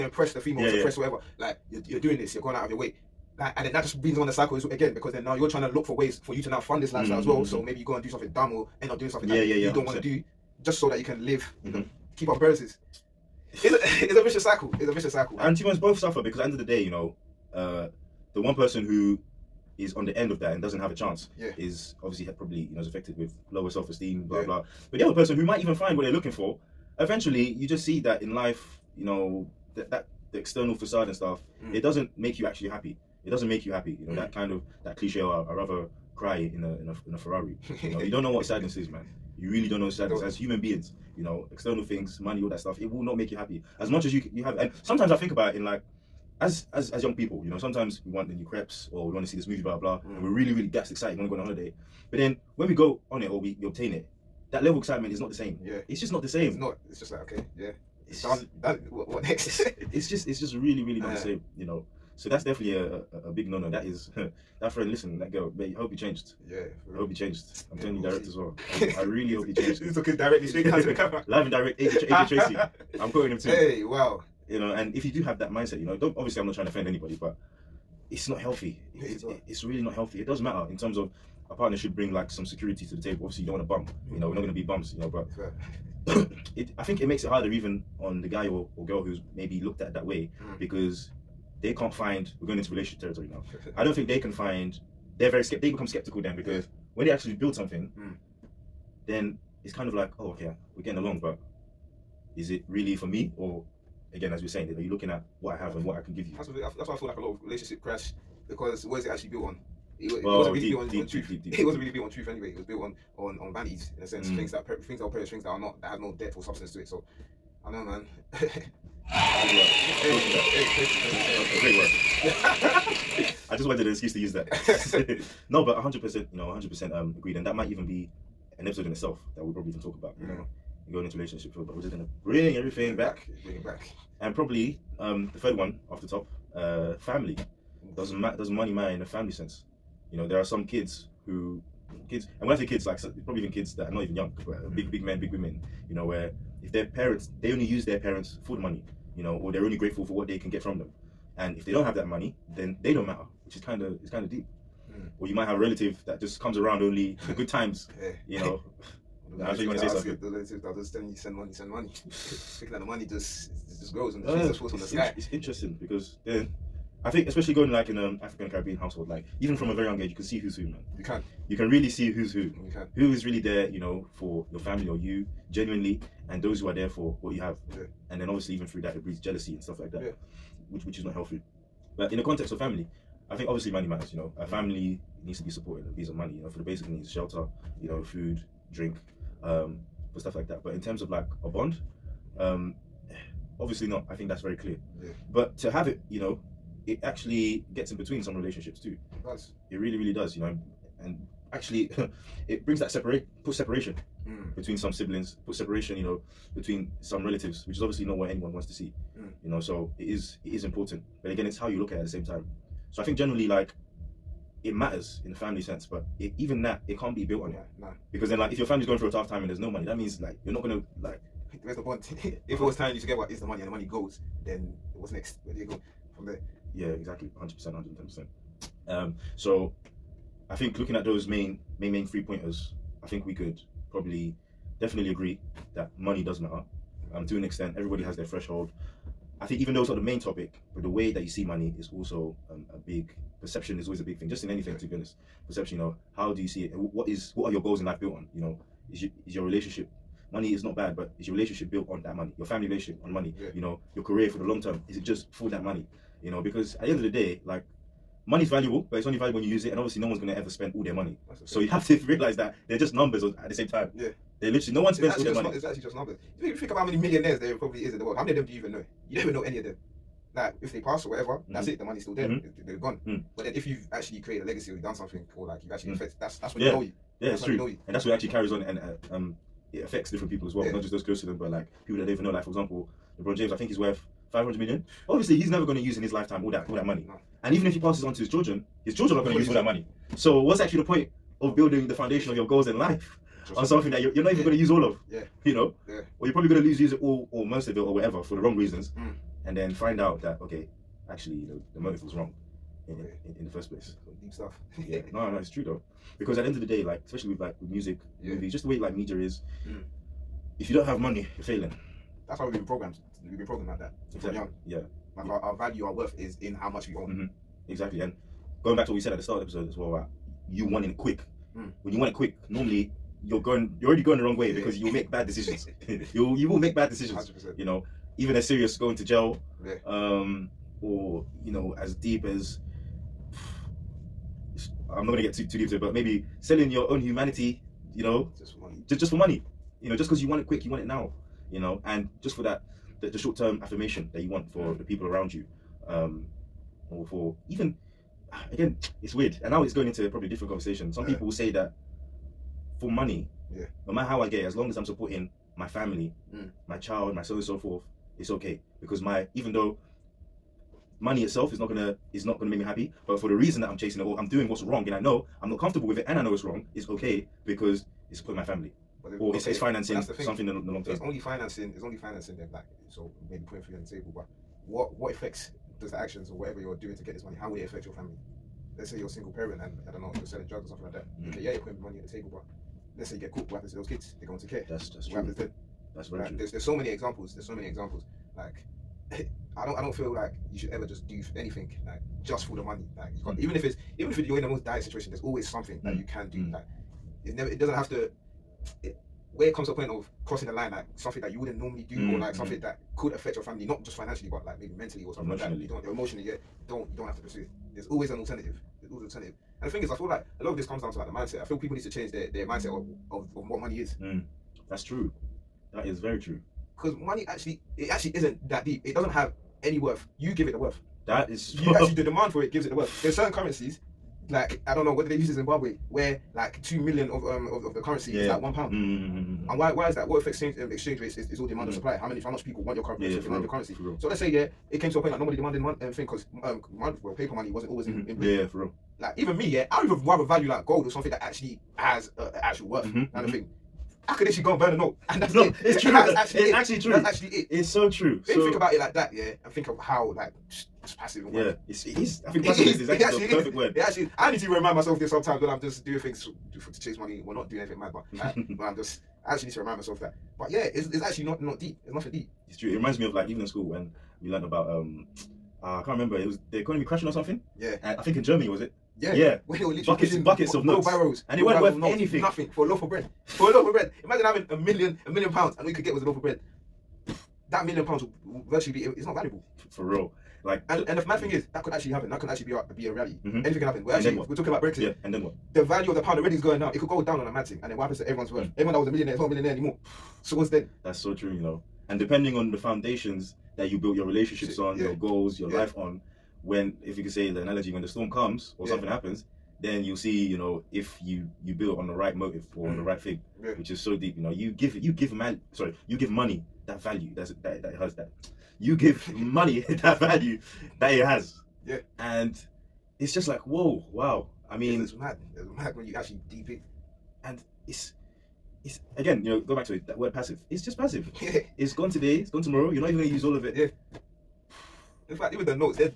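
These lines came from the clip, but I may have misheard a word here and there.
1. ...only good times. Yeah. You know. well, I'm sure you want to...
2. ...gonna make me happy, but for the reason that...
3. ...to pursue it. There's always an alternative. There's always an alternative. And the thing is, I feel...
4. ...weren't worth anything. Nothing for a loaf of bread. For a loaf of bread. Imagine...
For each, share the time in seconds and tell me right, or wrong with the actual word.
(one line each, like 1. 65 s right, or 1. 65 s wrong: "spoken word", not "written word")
1. 156 s right
2. 362 s right
3. 407 s right
4. 471 s right.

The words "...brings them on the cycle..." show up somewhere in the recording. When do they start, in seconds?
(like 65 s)
4 s.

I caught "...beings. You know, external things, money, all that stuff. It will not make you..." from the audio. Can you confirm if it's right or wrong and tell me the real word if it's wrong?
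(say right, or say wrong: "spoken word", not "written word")
right.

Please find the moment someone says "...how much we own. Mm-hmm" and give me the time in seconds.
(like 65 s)
316 s.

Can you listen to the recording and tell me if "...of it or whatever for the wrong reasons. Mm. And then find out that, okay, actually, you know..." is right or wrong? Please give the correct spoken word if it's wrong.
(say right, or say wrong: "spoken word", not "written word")
right.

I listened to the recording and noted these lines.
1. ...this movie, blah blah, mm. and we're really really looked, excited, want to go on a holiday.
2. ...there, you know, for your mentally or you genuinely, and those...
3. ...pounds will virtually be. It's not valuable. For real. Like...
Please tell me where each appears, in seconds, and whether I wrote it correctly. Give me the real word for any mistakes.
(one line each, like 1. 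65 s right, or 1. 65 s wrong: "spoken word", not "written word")
1. 49 s wrong: "gassed", not "looked"
2. 173 s wrong: "family", not "mentally"
3. 477 s right.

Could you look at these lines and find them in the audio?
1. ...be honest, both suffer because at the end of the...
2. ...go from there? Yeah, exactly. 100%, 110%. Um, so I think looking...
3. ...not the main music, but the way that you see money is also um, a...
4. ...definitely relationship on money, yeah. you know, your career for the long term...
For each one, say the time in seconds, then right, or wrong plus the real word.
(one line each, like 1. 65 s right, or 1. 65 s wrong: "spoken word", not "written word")
1. 15 s right
2. 225 s right
3. 239 s wrong: "topic", not "music"
4. 252 s wrong: "family", not "definitely".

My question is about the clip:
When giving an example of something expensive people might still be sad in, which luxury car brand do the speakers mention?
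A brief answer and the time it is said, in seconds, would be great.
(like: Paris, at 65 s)
Ferrari, at 37 s.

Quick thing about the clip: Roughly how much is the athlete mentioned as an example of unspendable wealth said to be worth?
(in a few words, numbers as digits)
500 million.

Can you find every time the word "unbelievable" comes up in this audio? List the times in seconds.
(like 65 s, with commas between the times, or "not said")
not said.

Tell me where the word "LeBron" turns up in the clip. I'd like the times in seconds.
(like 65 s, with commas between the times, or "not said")
283 s.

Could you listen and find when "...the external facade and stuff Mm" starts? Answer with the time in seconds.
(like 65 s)
30 s.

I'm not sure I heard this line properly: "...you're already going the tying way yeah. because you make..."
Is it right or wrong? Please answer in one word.
wrong.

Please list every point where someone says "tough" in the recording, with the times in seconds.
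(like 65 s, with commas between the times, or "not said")
219 s.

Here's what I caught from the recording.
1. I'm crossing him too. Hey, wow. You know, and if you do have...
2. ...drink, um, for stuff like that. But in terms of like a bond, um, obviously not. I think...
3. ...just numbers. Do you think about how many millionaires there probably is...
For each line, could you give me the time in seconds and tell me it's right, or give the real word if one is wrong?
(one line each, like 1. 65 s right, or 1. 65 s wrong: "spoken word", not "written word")
1. 73 s wrong: "quoting", not "crossing"
2. 188 s right
3. 265 s right.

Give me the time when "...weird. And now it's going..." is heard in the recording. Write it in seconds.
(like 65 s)
349 s.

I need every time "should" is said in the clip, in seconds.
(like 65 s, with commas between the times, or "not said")
81 s, 390 s.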